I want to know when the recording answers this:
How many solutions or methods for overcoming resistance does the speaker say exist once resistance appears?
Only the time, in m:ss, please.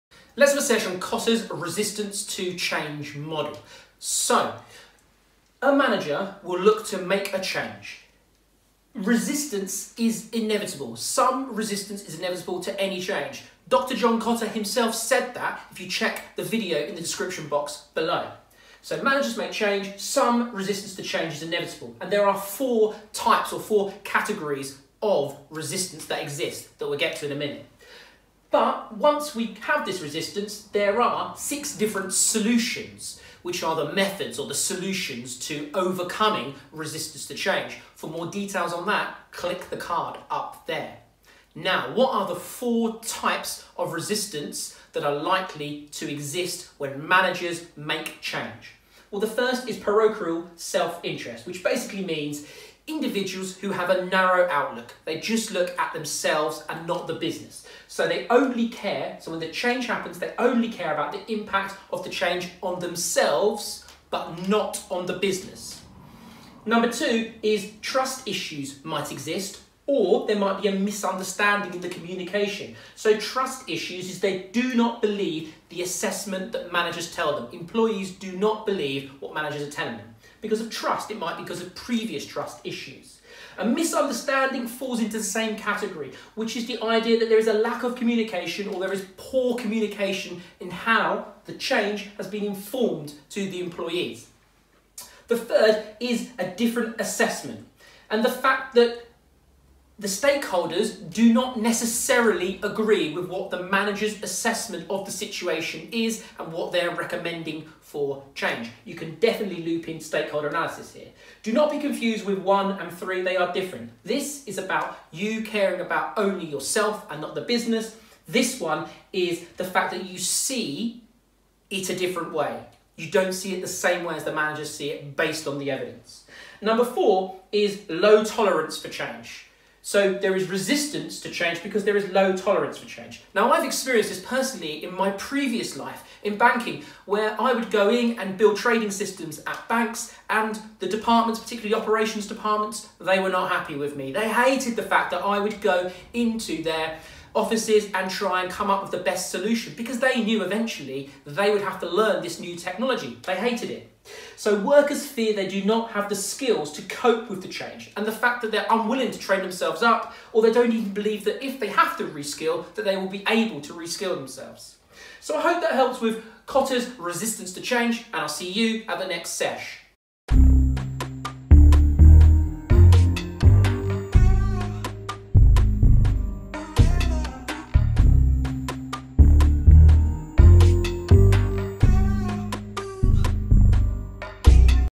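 0:31.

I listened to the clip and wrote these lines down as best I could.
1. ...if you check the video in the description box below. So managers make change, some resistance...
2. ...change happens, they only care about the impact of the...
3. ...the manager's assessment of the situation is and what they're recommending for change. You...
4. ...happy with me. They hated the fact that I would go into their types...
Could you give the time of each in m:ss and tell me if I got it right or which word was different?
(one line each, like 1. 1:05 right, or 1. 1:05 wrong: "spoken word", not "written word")
1. 0:15 right
2. 0:59 right
3. 1:43 right
4. 2:23 wrong: "offices", not "types".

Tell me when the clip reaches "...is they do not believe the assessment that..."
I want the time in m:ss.
1:14.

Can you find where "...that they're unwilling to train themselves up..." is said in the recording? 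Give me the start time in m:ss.
2:38.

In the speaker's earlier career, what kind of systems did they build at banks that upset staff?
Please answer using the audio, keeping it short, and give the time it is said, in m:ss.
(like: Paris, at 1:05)
Trading systems, at 2:18.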